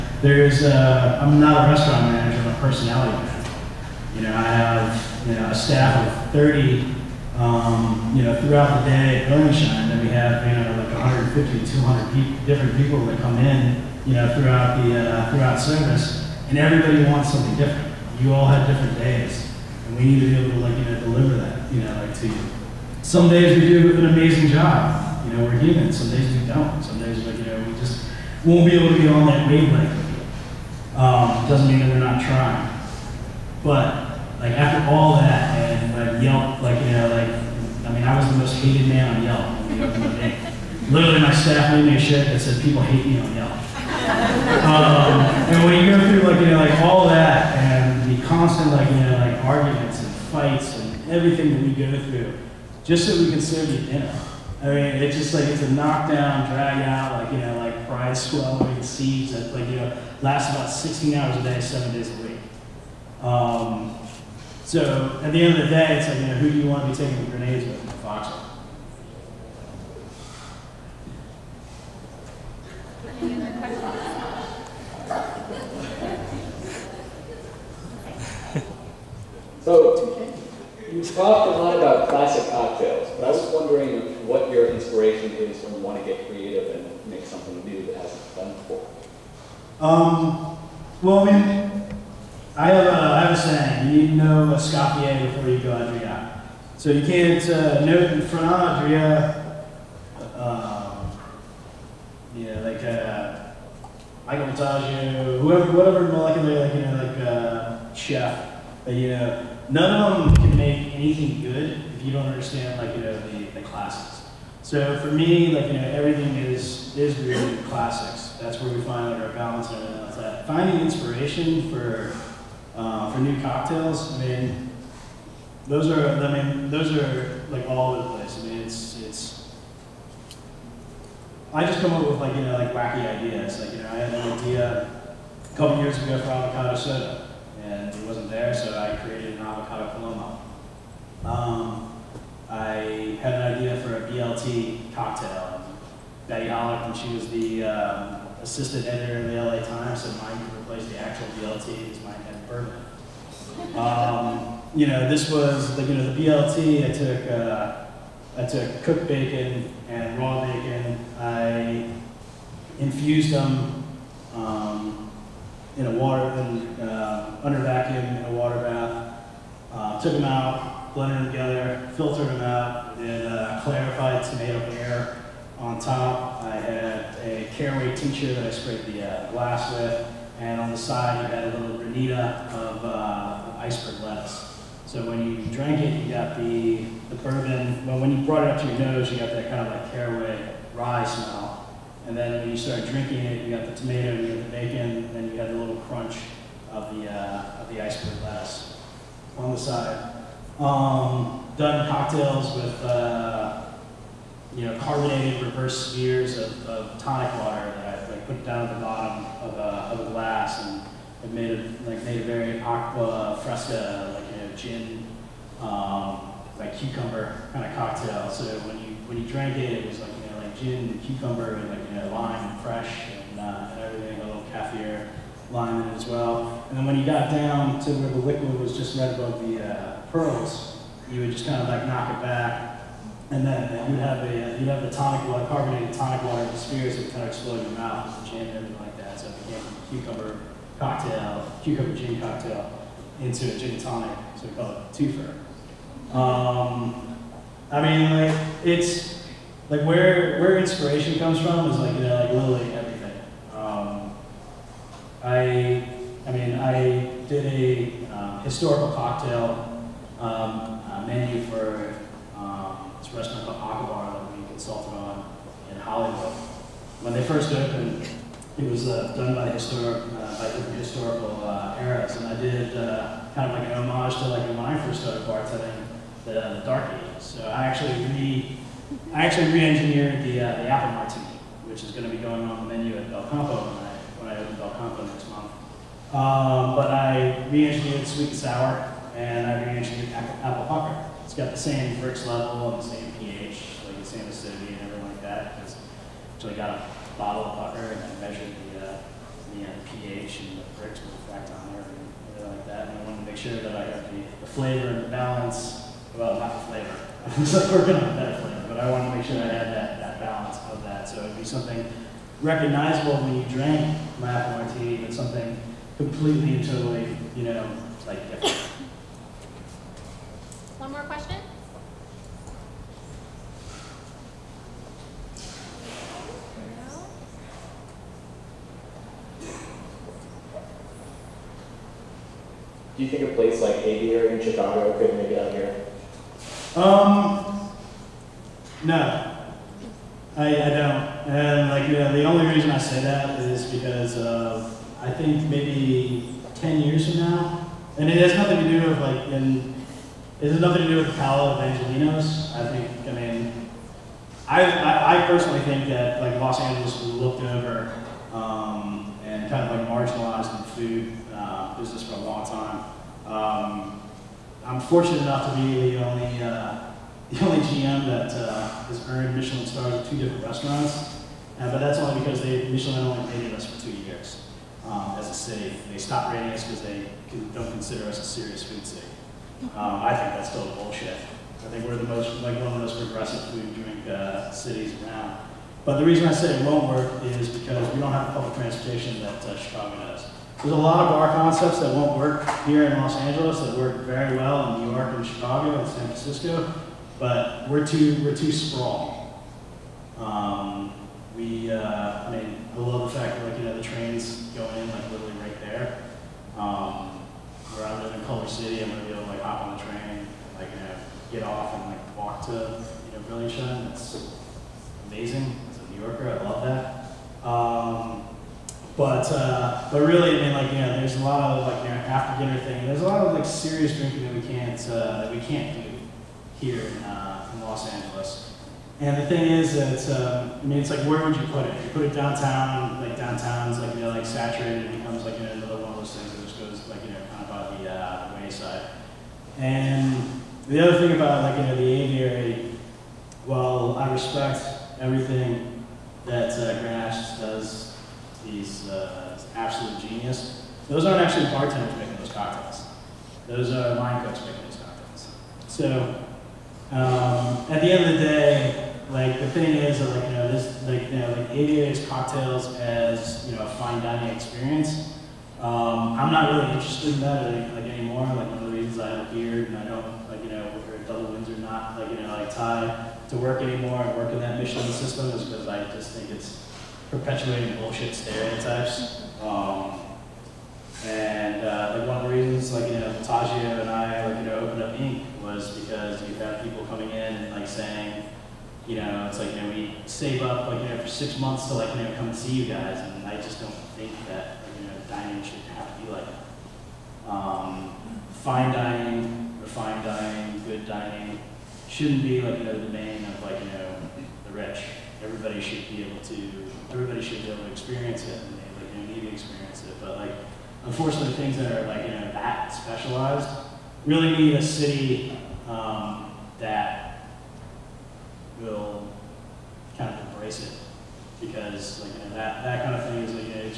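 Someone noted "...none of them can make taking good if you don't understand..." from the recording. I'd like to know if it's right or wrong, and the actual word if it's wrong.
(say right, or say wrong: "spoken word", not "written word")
wrong: "anything", not "taking".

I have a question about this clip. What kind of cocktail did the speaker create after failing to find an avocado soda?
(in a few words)
avocado paloma.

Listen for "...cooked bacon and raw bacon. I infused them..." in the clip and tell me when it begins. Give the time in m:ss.
2:38.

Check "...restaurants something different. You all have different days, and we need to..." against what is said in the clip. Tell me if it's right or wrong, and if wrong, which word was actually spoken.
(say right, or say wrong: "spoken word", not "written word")
wrong: "wants", not "restaurants".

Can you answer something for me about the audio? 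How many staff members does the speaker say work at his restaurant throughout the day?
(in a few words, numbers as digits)
30.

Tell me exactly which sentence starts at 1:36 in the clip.
So you can't uh, know it in front of Adria.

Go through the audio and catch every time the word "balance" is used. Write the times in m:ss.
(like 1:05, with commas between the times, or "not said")
1:59, 5:05, 5:10.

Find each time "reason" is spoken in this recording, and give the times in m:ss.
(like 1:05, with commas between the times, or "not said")
5:42, 6:26, 7:48, 8:02.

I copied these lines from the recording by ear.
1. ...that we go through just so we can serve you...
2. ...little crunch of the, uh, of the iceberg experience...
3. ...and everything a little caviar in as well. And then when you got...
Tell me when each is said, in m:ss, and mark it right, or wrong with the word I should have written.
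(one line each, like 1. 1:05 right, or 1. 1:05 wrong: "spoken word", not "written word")
1. 0:51 right
2. 3:15 wrong: "lettuce", not "experience"
3. 3:43 right.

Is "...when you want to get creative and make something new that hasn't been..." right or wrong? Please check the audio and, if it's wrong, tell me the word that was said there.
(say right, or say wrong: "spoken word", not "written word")
right.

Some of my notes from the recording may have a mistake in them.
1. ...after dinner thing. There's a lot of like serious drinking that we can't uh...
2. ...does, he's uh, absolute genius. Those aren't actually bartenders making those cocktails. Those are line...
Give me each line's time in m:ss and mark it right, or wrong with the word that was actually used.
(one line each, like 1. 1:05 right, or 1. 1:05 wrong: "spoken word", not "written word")
1. 7:02 right
2. 7:27 right.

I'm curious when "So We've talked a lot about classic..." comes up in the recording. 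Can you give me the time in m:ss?
1:19.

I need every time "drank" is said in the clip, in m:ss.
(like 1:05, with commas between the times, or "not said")
3:05, 3:39.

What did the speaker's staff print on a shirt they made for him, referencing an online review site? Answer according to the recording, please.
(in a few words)
People hate me on Yelp.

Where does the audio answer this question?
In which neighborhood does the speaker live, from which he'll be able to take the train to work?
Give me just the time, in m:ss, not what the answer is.
6:48.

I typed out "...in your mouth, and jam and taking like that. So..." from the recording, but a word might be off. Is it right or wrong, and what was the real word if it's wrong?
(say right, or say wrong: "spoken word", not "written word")
wrong: "everything", not "taking".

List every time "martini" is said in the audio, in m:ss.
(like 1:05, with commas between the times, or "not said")
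4:40, 5:14.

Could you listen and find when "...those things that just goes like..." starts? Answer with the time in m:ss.
7:15.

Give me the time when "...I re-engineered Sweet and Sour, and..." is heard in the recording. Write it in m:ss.
4:46.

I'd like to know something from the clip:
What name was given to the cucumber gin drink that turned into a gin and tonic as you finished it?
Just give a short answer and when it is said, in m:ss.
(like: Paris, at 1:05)
twofer, at 4:04.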